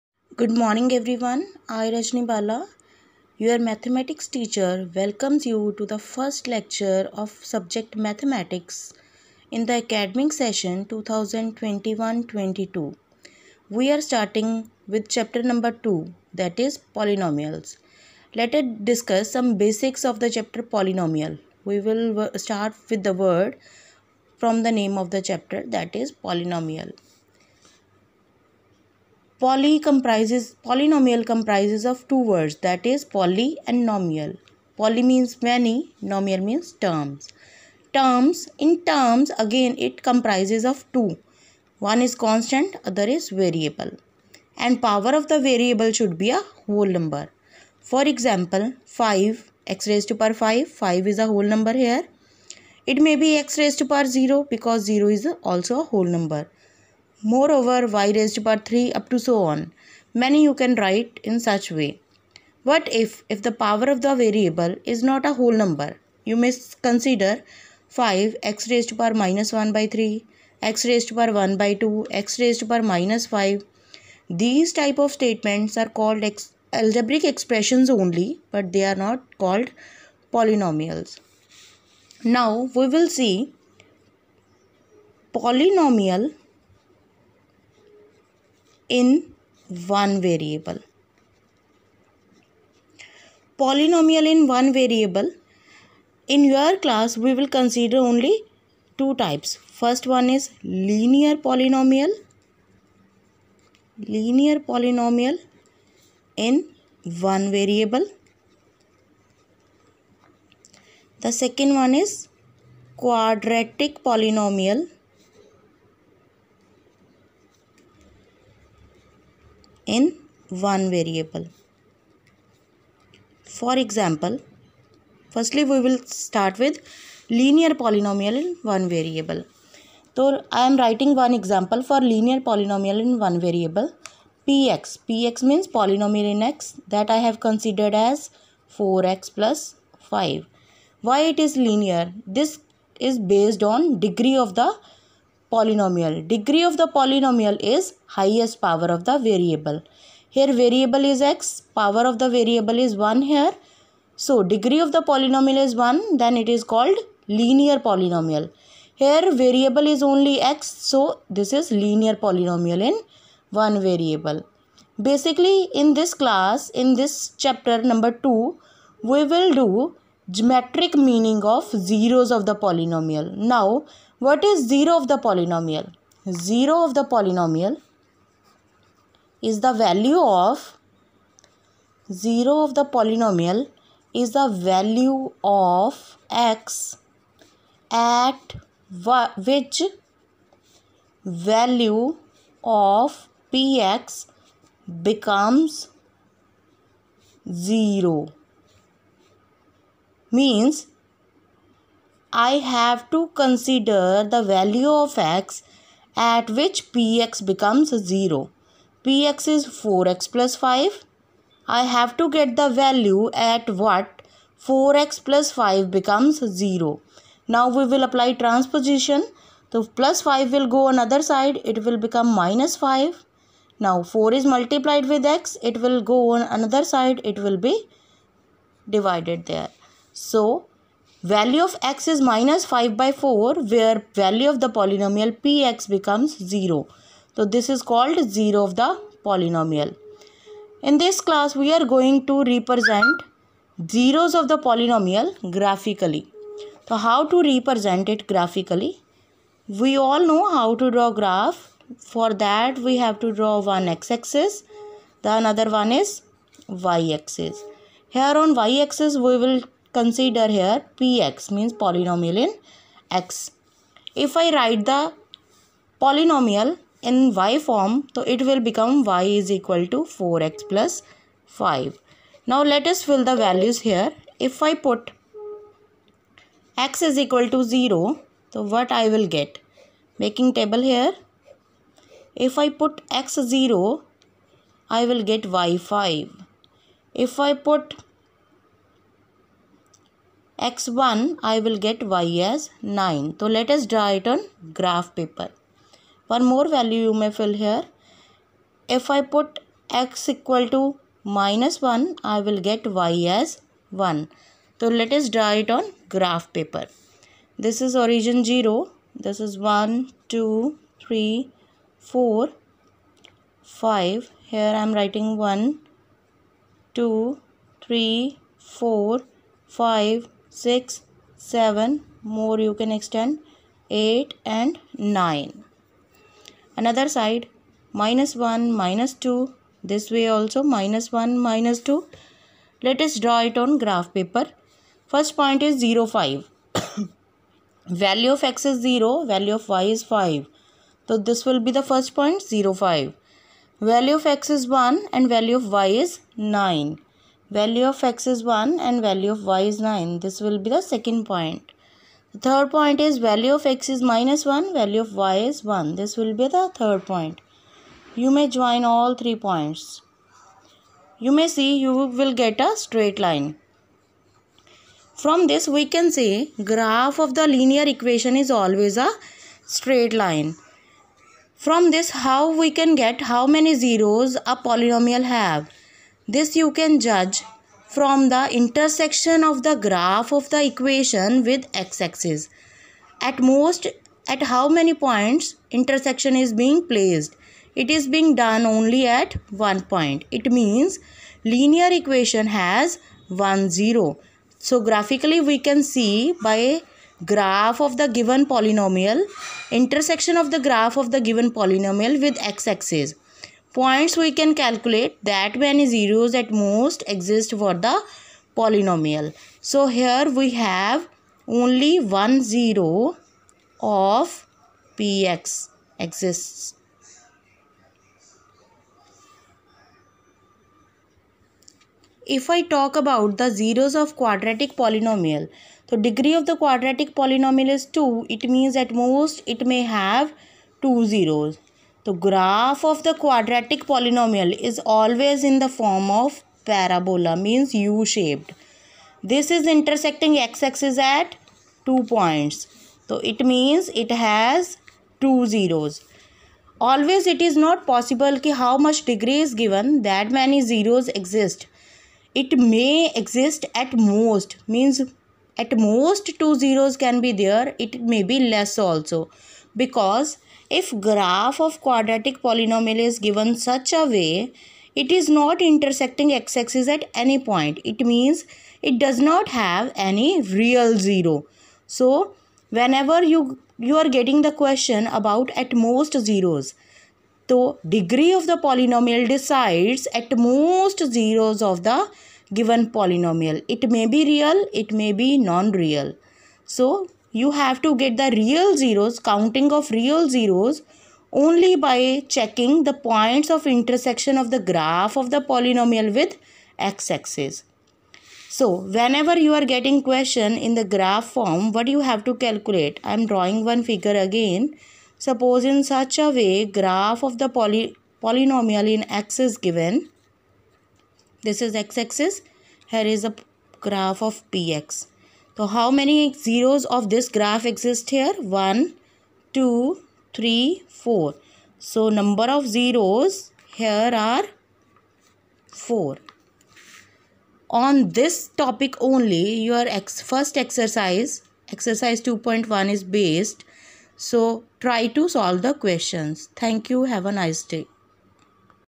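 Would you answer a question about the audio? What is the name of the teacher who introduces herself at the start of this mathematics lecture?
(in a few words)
Rajni Bala.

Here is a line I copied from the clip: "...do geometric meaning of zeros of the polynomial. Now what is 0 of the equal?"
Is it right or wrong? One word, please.
wrong.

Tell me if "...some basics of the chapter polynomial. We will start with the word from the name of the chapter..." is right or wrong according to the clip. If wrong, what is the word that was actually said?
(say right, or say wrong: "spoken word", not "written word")
right.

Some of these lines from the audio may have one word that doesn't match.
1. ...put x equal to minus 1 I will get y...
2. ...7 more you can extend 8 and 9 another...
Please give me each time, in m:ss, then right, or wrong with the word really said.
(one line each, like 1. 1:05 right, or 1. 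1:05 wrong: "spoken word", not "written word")
1. 4:59 right
2. 5:21 right.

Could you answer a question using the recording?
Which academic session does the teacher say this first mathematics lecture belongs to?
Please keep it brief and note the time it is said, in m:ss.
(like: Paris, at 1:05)
2021-22, at 0:10.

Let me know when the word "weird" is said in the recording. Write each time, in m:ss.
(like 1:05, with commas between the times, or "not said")
not said.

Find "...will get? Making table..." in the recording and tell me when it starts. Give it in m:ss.
4:39.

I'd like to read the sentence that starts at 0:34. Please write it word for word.
Poly means many, nomial means terms.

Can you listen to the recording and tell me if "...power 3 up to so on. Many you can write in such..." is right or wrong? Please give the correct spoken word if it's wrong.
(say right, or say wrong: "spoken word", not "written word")
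right.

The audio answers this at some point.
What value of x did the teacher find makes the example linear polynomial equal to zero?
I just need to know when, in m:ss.
3:52.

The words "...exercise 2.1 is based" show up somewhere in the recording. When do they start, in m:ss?
8:51.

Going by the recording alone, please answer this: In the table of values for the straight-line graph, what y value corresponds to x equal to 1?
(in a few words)
9.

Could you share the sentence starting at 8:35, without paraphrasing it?
So how many zeros of this graph exist here?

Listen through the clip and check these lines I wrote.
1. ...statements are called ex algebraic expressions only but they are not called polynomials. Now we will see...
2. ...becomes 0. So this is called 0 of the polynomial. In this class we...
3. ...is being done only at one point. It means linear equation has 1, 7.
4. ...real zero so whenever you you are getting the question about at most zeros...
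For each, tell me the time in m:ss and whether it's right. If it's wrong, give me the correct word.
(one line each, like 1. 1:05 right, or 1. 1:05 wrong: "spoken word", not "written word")
1. 1:15 right
2. 3:55 right
3. 6:27 wrong: "0", not "7"
4. 7:50 right.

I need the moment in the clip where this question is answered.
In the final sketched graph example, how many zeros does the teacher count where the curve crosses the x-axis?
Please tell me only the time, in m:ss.
8:42.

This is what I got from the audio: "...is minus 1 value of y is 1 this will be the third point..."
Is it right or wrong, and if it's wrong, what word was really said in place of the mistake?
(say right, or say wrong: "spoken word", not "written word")
right.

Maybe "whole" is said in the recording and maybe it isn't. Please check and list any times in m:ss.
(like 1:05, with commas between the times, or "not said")
0:46, 0:51, 0:55, 1:05.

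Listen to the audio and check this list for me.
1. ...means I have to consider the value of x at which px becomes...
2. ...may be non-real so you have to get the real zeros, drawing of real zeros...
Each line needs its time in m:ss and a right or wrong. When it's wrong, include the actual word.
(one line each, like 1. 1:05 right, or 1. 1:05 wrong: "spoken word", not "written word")
1. 3:20 right
2. 8:04 wrong: "counting", not "drawing".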